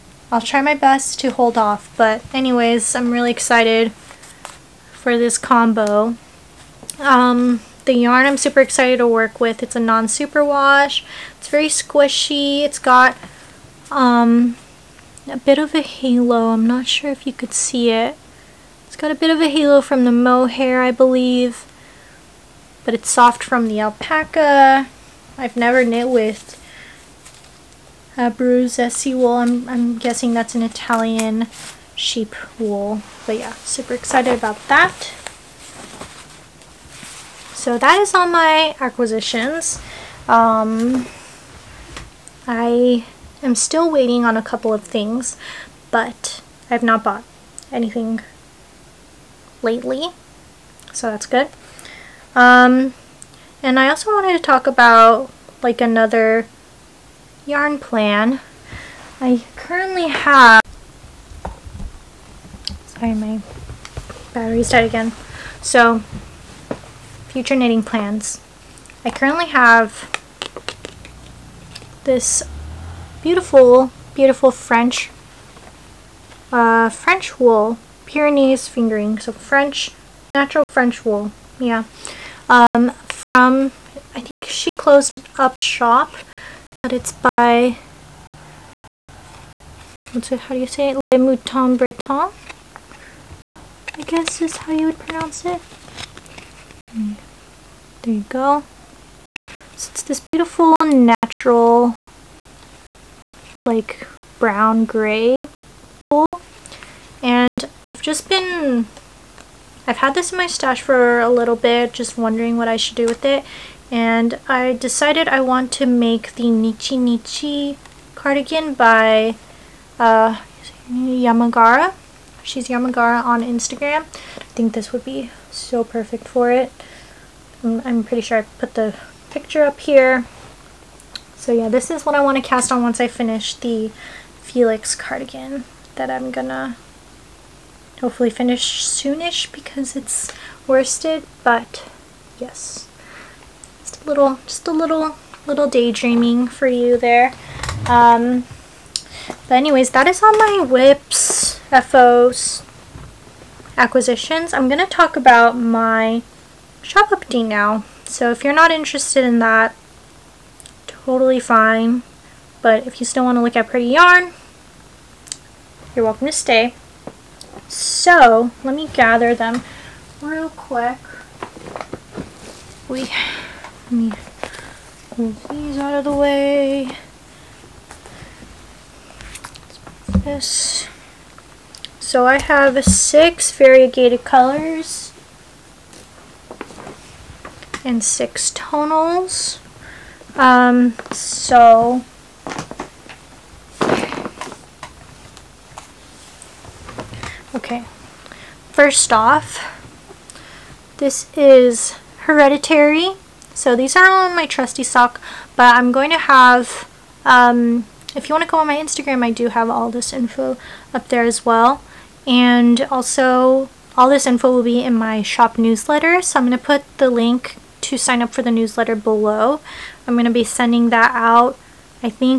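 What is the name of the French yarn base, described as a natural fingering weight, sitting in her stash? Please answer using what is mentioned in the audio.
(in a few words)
Pyrenees fingering.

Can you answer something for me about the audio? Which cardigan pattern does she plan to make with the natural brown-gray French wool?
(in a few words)
Nichi Nichi cardigan.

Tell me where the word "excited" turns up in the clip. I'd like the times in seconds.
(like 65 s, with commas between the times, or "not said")
3 s, 8 s, 33 s.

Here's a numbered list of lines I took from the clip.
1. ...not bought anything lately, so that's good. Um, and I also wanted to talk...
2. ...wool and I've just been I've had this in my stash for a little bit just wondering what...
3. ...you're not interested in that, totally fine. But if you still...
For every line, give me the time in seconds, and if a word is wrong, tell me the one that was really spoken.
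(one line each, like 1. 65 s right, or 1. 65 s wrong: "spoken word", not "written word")
1. 46 s right
2. 106 s right
3. 158 s right.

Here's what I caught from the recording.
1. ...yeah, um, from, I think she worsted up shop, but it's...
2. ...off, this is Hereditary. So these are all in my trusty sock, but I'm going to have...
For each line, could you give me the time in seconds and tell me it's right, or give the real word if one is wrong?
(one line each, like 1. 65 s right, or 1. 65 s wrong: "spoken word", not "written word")
1. 81 s wrong: "closed", not "worsted"
2. 199 s right.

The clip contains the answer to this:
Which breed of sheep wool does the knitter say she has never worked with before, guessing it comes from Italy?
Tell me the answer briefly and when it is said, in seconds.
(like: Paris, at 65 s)
Abruzzese, at 28 s.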